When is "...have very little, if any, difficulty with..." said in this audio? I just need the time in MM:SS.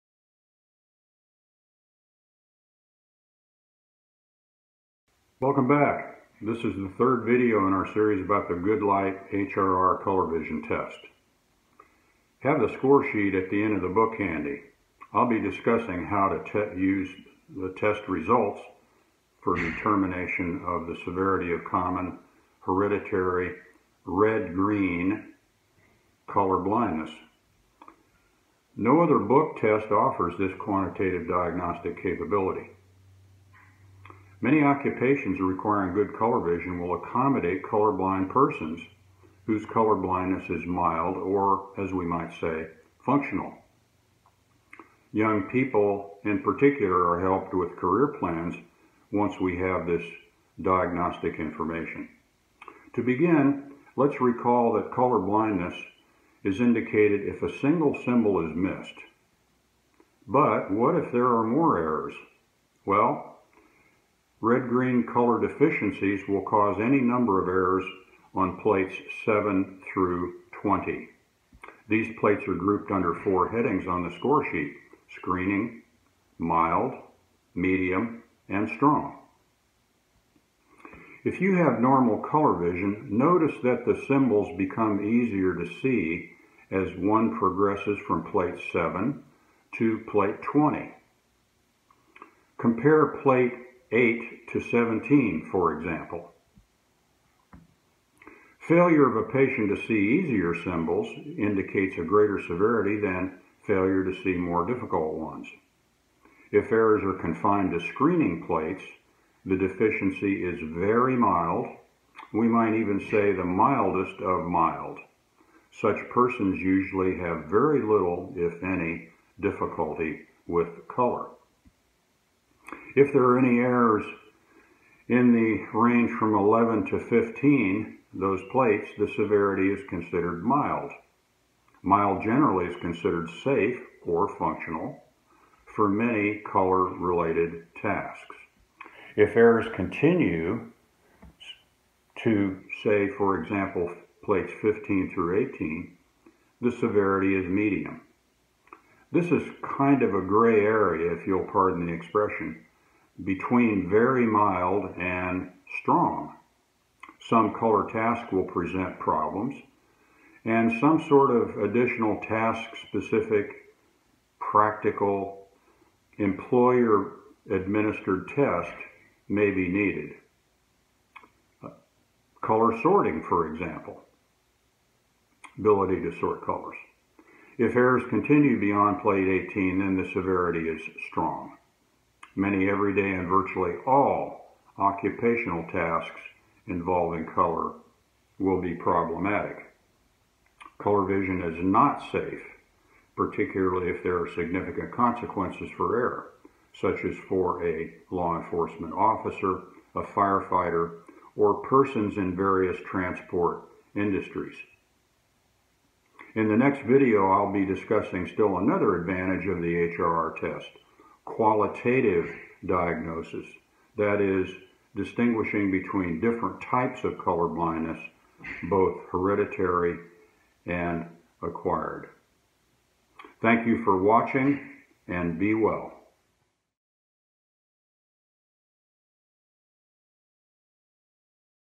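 01:57.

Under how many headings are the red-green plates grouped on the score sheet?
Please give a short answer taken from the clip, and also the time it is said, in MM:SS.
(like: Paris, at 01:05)
4, at 01:13.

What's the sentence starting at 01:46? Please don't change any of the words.
If errors are confined to screening plates, the deficiency is very mild.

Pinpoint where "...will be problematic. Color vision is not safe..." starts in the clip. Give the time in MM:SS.
03:08.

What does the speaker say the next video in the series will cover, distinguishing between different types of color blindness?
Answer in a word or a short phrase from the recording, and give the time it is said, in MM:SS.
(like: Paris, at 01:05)
qualitative diagnosis, at 03:31.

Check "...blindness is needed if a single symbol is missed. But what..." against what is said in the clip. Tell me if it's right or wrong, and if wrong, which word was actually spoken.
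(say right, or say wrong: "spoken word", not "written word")
wrong: "indicated", not "needed".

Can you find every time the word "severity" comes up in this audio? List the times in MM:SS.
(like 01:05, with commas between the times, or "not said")
00:21, 01:42, 02:09, 02:26, 03:00.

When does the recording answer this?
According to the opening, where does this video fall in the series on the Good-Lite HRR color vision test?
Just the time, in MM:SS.
00:06.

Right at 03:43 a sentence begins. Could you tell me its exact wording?
Thank you for watching and be well.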